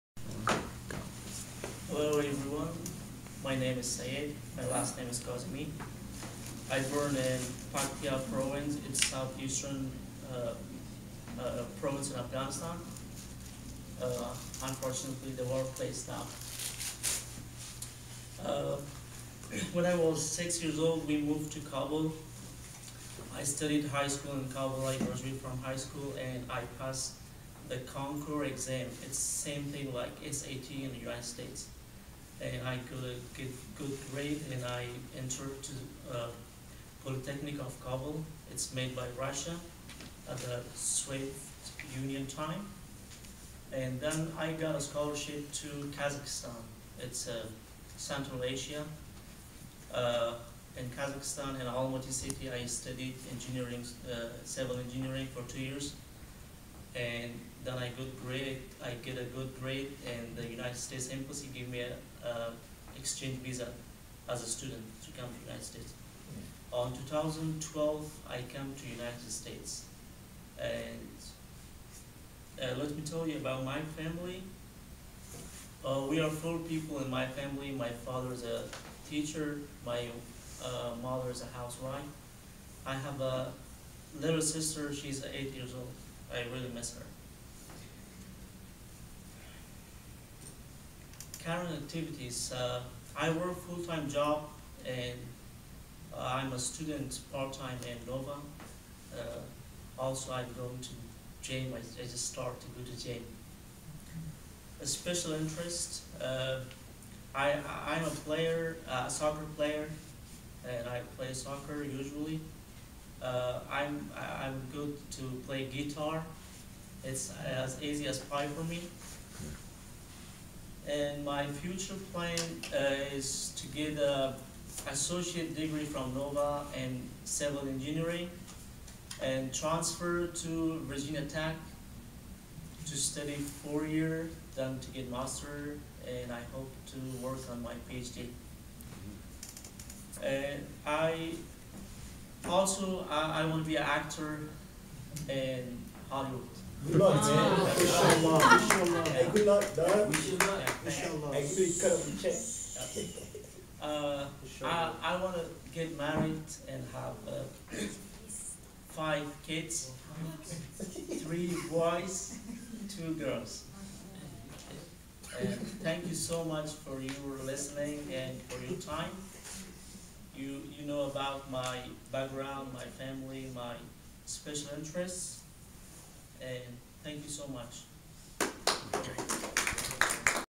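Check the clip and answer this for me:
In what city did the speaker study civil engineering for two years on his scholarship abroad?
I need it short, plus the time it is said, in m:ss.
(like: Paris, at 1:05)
Almaty, at 0:51.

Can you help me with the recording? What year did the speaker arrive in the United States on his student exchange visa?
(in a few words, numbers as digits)
2012.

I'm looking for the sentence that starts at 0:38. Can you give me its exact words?
It's made by Russia at the Soviet Union time.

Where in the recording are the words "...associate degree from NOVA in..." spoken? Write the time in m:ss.
2:04.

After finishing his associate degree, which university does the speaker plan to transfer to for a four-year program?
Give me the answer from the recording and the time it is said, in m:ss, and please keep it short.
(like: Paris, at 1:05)
Virginia Tech, at 2:10.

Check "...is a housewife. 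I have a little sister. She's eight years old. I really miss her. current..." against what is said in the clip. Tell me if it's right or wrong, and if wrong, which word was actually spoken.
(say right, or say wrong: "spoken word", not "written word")
right.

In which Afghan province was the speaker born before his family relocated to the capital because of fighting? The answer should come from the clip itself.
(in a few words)
Paktia.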